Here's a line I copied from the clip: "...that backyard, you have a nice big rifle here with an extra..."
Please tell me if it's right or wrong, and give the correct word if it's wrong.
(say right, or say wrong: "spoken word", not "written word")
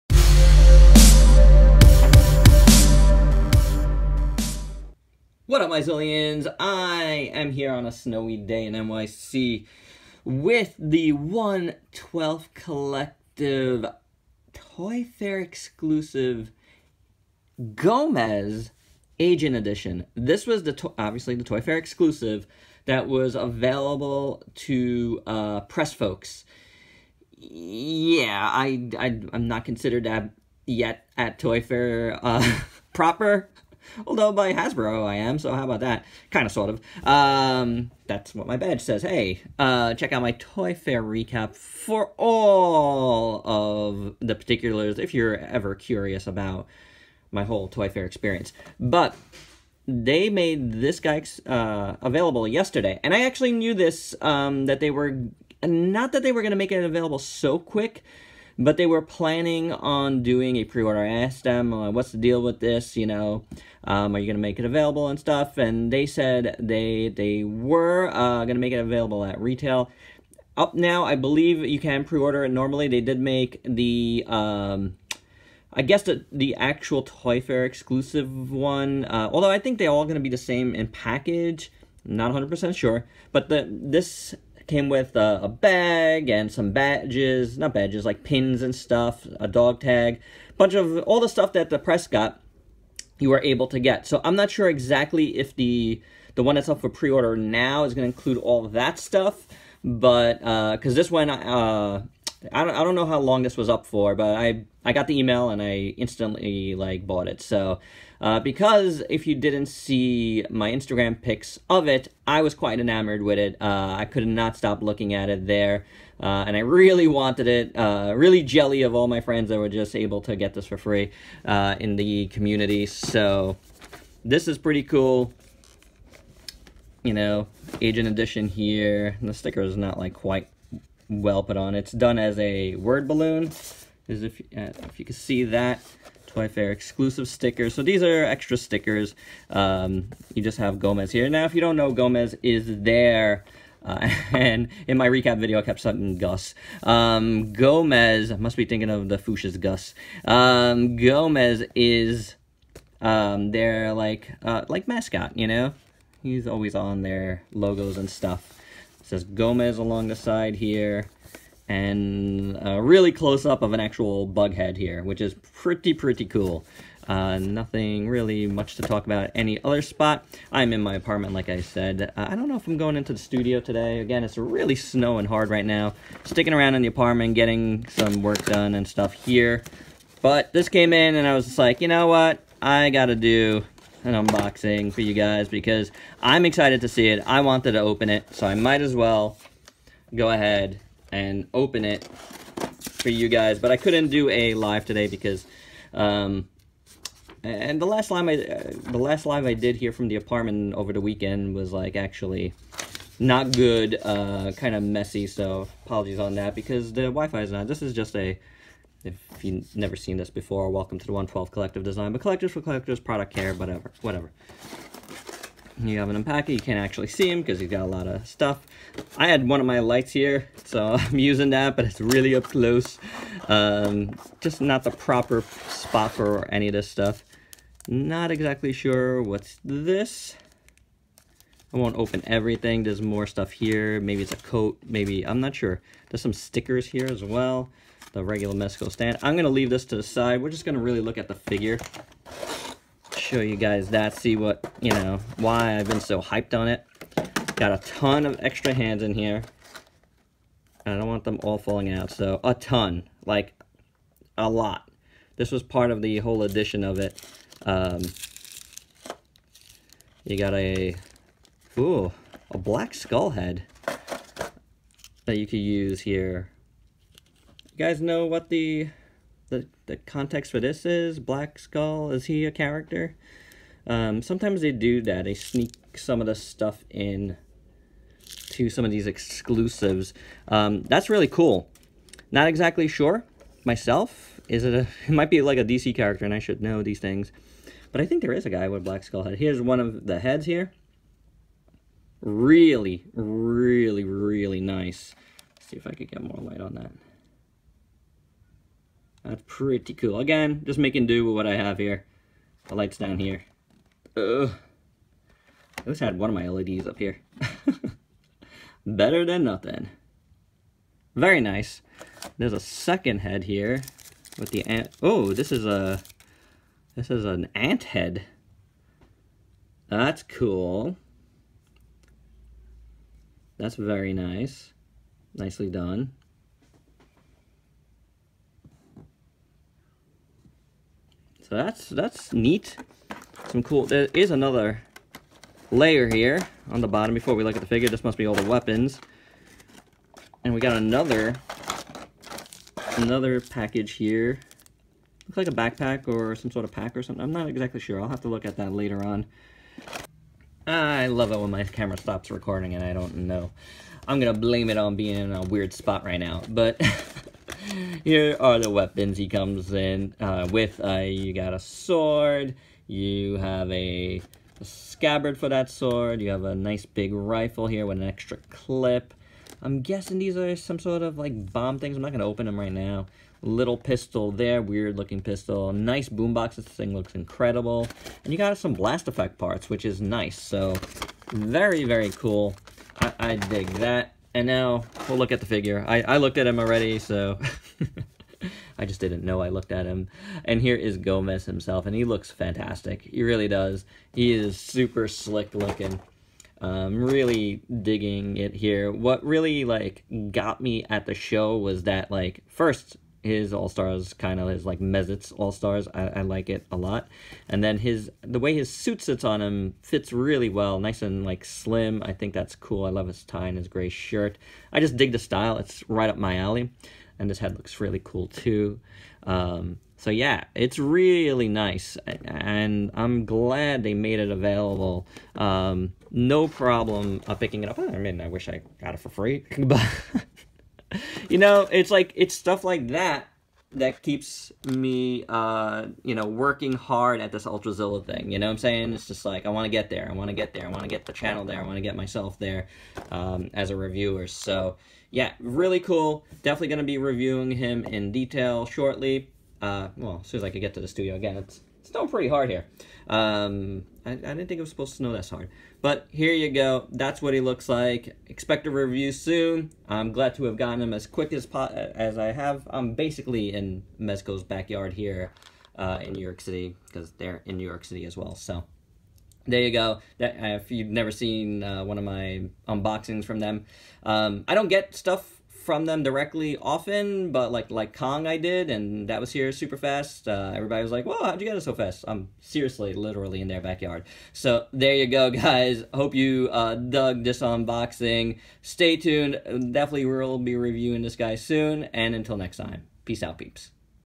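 wrong: "sword", not "backyard".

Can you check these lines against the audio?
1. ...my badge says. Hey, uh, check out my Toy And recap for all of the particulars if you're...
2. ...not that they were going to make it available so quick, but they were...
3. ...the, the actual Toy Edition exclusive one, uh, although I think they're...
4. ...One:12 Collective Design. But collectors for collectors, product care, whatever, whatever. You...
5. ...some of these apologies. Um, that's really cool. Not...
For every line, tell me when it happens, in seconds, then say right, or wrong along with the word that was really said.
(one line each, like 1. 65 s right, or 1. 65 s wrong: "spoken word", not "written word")
1. 38 s wrong: "Fair", not "And"
2. 55 s right
3. 76 s wrong: "Fair", not "Edition"
4. 211 s right
5. 278 s wrong: "exclusives", not "apologies".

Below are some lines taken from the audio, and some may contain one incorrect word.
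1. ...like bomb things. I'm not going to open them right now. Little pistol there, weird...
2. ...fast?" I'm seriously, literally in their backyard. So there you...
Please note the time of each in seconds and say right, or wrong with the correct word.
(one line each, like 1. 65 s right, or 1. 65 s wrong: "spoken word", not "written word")
1. 371 s right
2. 481 s right.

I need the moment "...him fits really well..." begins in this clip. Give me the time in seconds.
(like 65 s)
409 s.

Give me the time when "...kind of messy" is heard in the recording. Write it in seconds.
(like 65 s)
204 s.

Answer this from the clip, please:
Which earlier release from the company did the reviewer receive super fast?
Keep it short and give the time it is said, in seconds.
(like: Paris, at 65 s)
Kong, at 477 s.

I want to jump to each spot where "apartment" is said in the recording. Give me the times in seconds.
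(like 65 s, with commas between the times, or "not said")
170 s, 176 s, 200 s.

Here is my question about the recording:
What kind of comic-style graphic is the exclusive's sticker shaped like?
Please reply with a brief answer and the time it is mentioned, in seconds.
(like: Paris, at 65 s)
Word balloon, at 132 s.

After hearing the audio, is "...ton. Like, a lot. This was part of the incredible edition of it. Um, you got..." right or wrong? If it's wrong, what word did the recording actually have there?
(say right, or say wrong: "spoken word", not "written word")
wrong: "whole", not "incredible".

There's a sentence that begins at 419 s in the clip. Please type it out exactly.
Um, so yeah, it's really nice, and I'm glad they made it available.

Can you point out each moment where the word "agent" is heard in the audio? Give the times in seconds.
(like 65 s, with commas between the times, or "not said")
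19 s, 127 s.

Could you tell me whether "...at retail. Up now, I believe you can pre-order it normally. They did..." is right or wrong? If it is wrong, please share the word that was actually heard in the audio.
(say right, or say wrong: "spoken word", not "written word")
right.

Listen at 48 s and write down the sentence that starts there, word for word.
But they made this guy uh, available yesterday.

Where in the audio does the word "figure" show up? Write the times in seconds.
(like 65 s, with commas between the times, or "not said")
241 s, 337 s, 385 s.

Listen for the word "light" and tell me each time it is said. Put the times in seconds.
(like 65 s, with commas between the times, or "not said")
219 s, 296 s, 302 s.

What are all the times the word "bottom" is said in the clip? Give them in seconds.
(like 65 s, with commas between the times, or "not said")
336 s.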